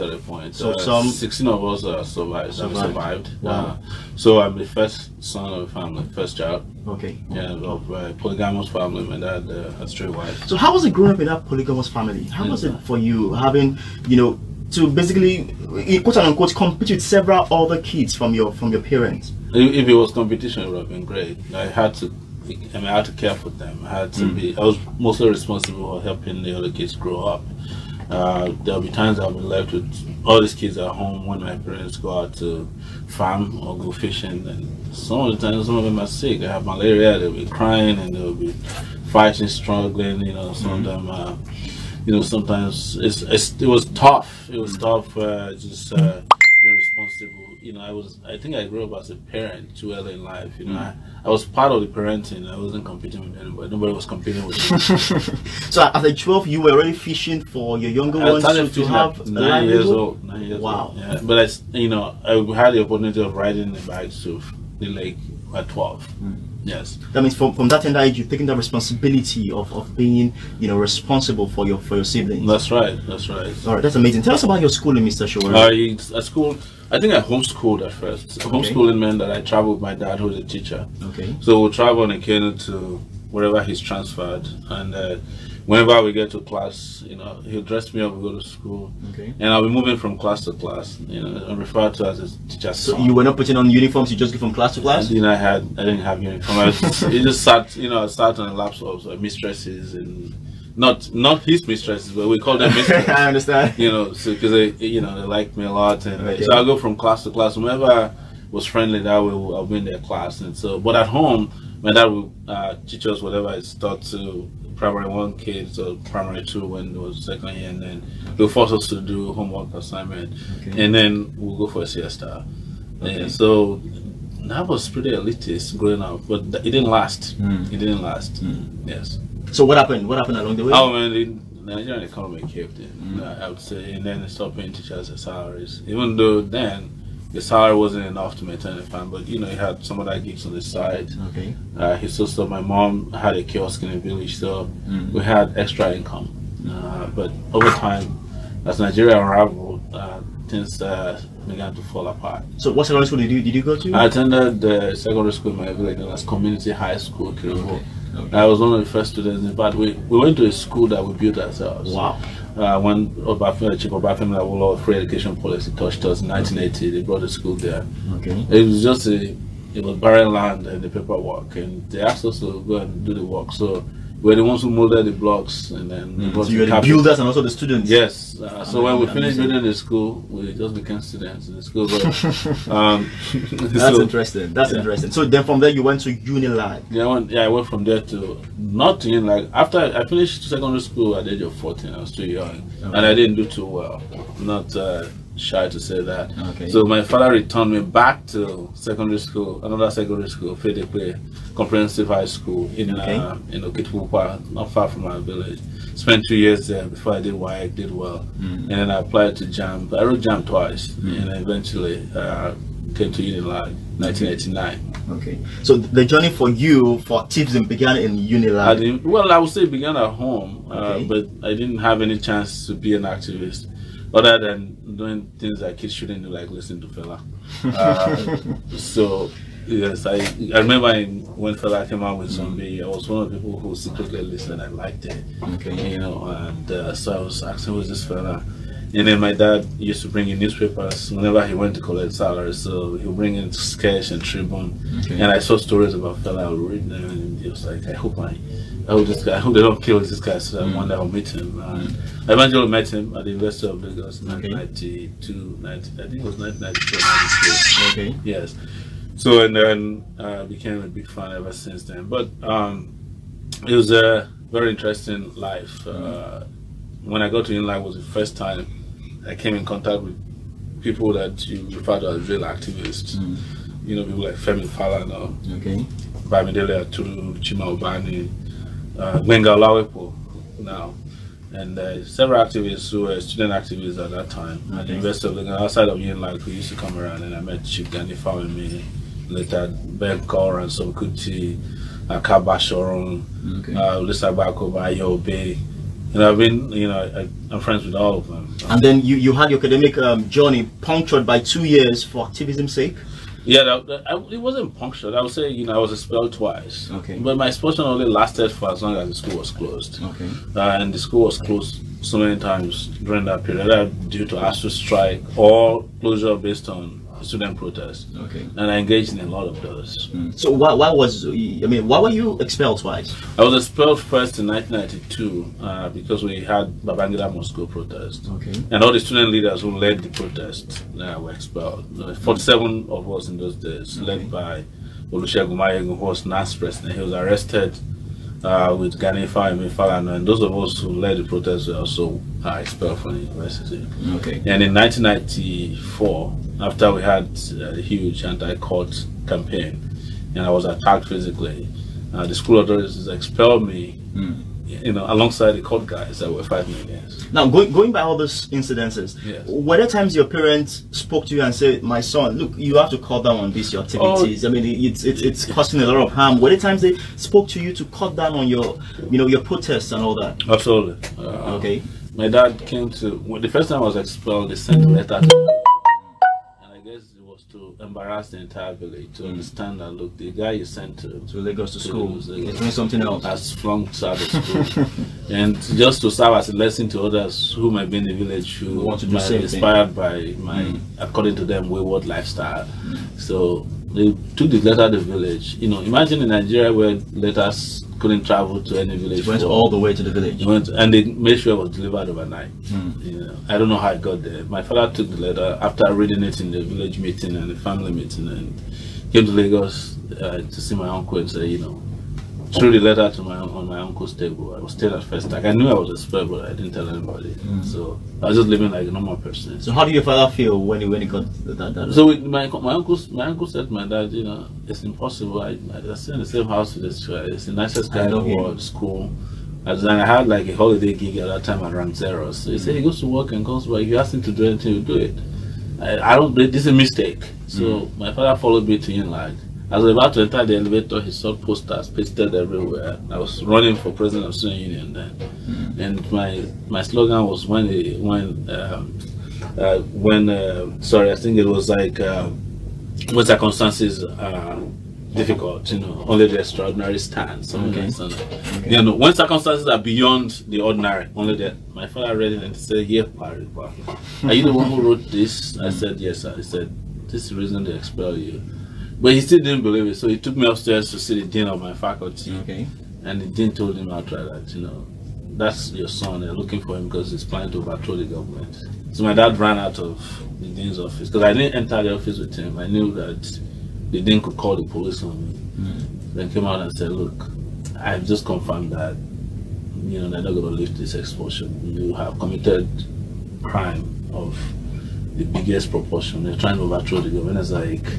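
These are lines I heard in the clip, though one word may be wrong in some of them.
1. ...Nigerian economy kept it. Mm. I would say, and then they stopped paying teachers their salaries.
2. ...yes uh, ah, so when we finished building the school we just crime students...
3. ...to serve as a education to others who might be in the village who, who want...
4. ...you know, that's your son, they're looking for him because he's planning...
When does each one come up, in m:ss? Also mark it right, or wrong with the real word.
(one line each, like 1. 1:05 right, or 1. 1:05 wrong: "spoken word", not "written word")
1. 2:11 right
2. 2:57 wrong: "became", not "crime"
3. 6:26 wrong: "lesson", not "education"
4. 7:54 right.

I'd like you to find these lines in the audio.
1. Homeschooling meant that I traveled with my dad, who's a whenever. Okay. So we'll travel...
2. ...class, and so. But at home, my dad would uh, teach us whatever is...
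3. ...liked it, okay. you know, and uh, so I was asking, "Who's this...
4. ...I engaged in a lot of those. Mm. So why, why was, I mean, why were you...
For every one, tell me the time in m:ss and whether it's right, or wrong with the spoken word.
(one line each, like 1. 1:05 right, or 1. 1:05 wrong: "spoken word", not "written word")
1. 1:18 wrong: "teacher", not "whenever"
2. 1:49 right
3. 3:54 right
4. 5:18 right.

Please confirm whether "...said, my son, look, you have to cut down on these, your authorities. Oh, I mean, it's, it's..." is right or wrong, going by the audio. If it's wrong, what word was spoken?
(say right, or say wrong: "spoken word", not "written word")
wrong: "activities", not "authorities".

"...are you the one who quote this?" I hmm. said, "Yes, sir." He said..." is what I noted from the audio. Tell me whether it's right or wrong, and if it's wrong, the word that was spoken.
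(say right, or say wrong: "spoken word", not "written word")
wrong: "wrote", not "quote".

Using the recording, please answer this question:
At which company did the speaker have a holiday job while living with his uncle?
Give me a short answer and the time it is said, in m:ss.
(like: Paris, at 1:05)
Rank Xerox, at 7:11.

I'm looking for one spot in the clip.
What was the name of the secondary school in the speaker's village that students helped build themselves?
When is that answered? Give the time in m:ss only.
2:36.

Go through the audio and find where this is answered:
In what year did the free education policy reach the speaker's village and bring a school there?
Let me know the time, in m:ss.
2:46.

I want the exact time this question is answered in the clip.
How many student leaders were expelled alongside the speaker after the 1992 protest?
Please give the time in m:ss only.
5:32.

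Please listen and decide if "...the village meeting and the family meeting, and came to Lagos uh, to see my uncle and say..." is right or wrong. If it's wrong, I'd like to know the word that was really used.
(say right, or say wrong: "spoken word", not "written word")
right.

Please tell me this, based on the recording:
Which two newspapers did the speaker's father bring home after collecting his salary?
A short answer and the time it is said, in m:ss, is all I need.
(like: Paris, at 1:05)
Sketch and Tribune, at 4:03.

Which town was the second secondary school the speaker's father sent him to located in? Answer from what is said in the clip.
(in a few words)
Okitipupa.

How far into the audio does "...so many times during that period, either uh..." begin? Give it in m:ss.
5:12.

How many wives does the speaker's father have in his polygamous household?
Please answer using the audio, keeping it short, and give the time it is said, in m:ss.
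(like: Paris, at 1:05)
3, at 0:09.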